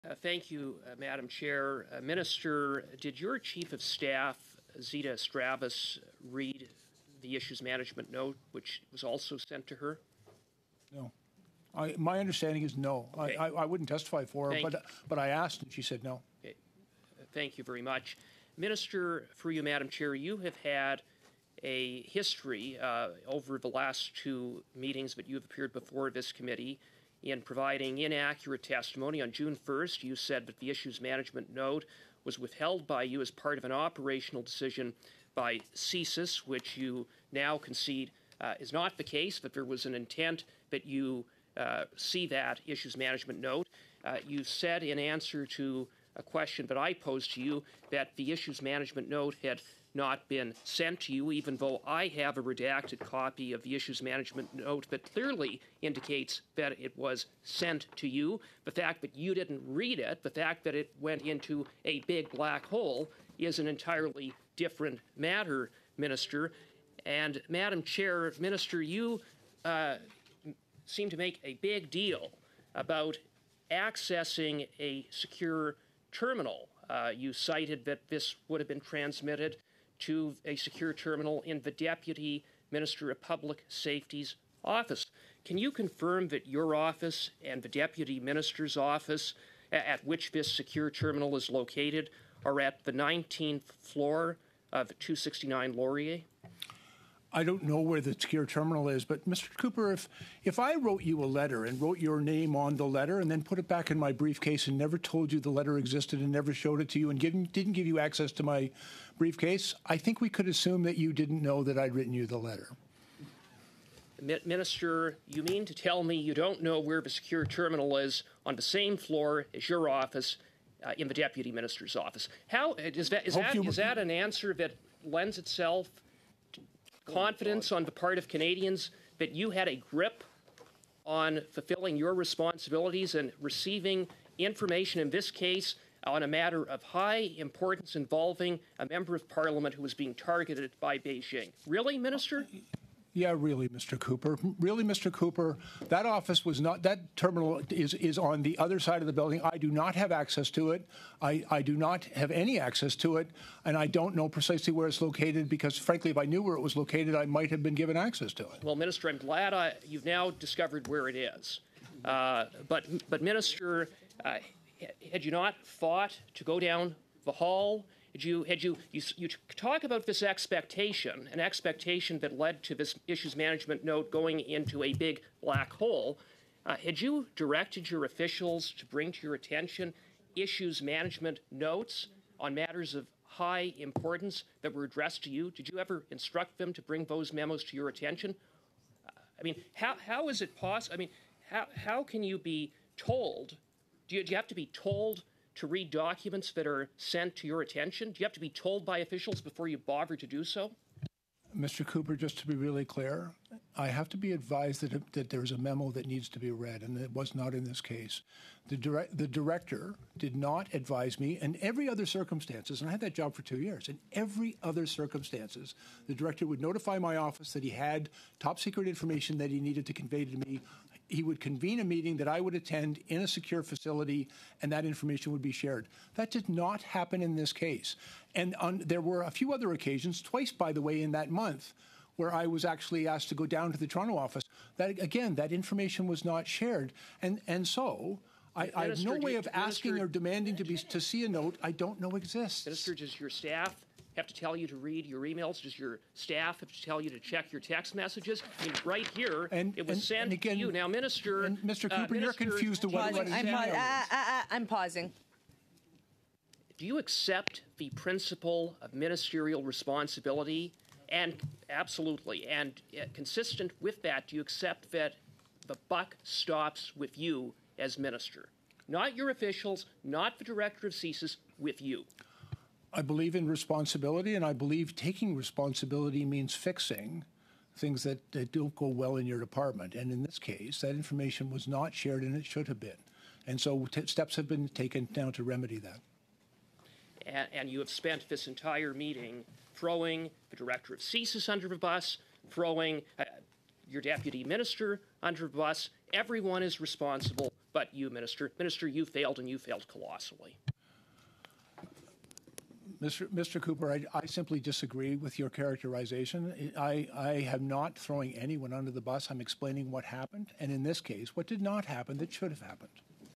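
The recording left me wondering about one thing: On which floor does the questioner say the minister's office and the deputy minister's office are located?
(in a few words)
19th floor.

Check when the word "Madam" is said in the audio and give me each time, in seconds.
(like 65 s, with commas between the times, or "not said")
0 s, 19 s, 67 s.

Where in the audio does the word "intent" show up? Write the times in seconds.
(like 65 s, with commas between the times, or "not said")
39 s.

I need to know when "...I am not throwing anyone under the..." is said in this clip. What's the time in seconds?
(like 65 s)
307 s.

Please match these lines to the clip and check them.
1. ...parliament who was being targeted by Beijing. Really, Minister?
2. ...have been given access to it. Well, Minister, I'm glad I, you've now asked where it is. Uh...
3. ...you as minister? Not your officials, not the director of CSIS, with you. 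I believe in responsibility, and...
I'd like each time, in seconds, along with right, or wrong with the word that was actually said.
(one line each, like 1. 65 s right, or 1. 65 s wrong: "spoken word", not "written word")
1. 139 s right
2. 157 s wrong: "discovered", not "asked"
3. 267 s right.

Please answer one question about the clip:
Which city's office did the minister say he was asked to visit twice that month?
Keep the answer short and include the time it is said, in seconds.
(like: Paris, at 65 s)
Toronto, at 233 s.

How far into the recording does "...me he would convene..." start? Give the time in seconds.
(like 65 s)
220 s.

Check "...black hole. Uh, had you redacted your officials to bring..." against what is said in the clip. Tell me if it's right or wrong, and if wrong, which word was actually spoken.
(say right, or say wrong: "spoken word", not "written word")
wrong: "directed", not "redacted".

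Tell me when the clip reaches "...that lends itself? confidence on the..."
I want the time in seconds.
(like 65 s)
124 s.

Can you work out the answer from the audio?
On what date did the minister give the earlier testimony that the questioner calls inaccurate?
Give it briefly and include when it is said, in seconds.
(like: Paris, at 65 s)
June 1, at 29 s.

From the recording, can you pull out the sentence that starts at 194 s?
Do you, do you have to be told to read documents that are sent to your attention?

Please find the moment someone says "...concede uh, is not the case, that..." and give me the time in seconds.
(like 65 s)
37 s.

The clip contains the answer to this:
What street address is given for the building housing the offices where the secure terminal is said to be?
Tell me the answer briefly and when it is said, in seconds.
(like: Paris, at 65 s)
269 Laurier, at 94 s.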